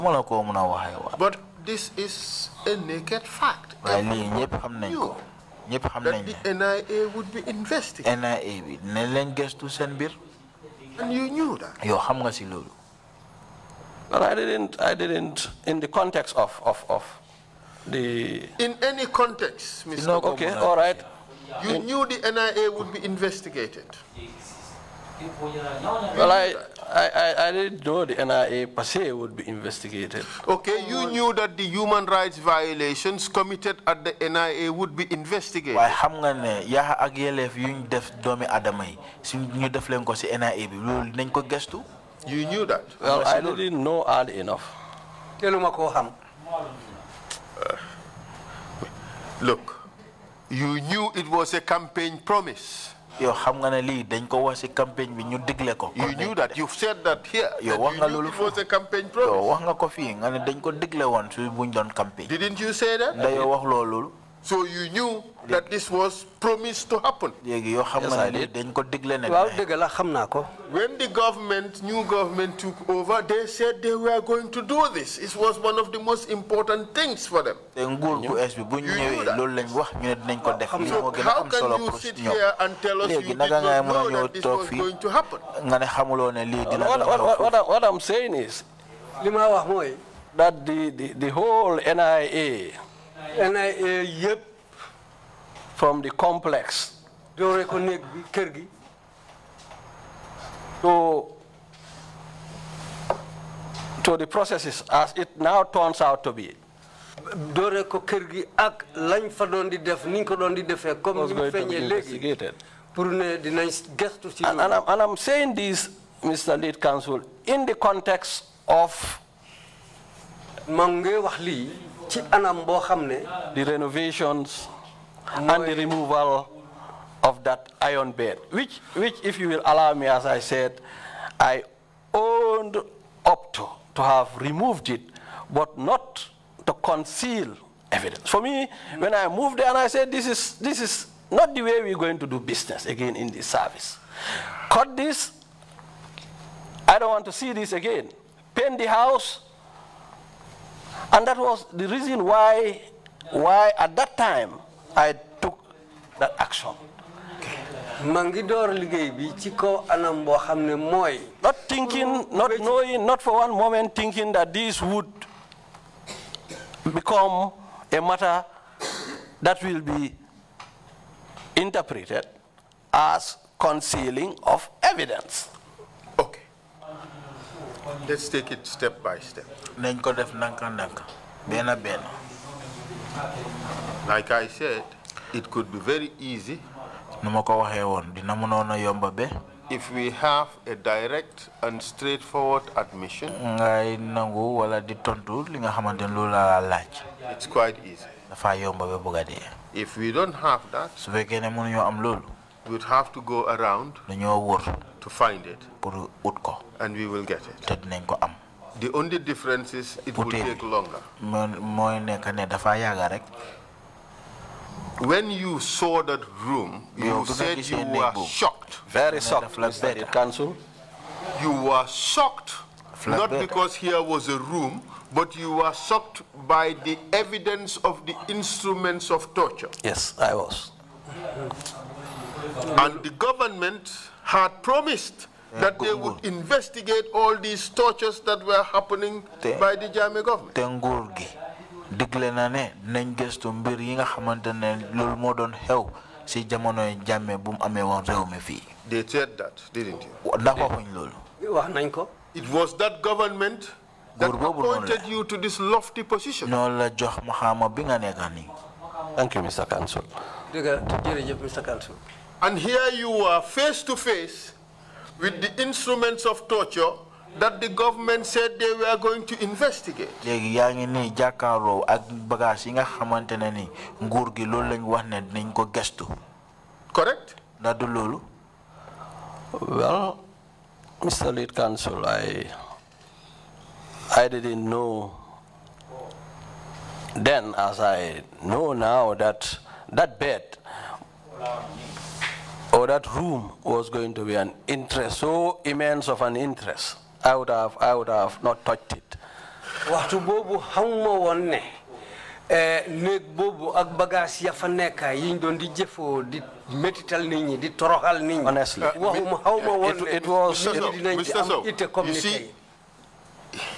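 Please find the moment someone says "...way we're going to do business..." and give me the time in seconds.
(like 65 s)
141 s.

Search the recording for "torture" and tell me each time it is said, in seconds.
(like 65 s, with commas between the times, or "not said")
229 s, 237 s, 266 s.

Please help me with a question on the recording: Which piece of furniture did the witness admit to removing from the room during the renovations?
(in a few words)
iron bed.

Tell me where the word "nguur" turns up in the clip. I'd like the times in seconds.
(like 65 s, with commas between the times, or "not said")
274 s.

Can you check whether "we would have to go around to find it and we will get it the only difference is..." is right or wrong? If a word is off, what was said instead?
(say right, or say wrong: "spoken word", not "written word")
right.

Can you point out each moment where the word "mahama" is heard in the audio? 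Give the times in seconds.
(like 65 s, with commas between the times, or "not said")
257 s.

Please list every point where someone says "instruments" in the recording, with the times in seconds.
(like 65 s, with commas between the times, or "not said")
228 s, 265 s.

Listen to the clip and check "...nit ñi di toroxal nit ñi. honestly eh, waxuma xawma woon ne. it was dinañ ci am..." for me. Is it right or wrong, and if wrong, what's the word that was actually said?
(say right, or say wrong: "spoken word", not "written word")
right.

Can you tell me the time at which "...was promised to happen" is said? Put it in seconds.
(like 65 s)
65 s.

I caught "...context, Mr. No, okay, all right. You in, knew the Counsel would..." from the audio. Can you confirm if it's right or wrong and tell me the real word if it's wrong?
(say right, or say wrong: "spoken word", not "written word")
wrong: "NIA", not "Counsel".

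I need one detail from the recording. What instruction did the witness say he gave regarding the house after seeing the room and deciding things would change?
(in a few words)
Paint the house.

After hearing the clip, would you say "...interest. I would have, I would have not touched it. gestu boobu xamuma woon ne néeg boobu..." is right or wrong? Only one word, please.
wrong.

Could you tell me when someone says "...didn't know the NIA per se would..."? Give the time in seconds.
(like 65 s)
27 s.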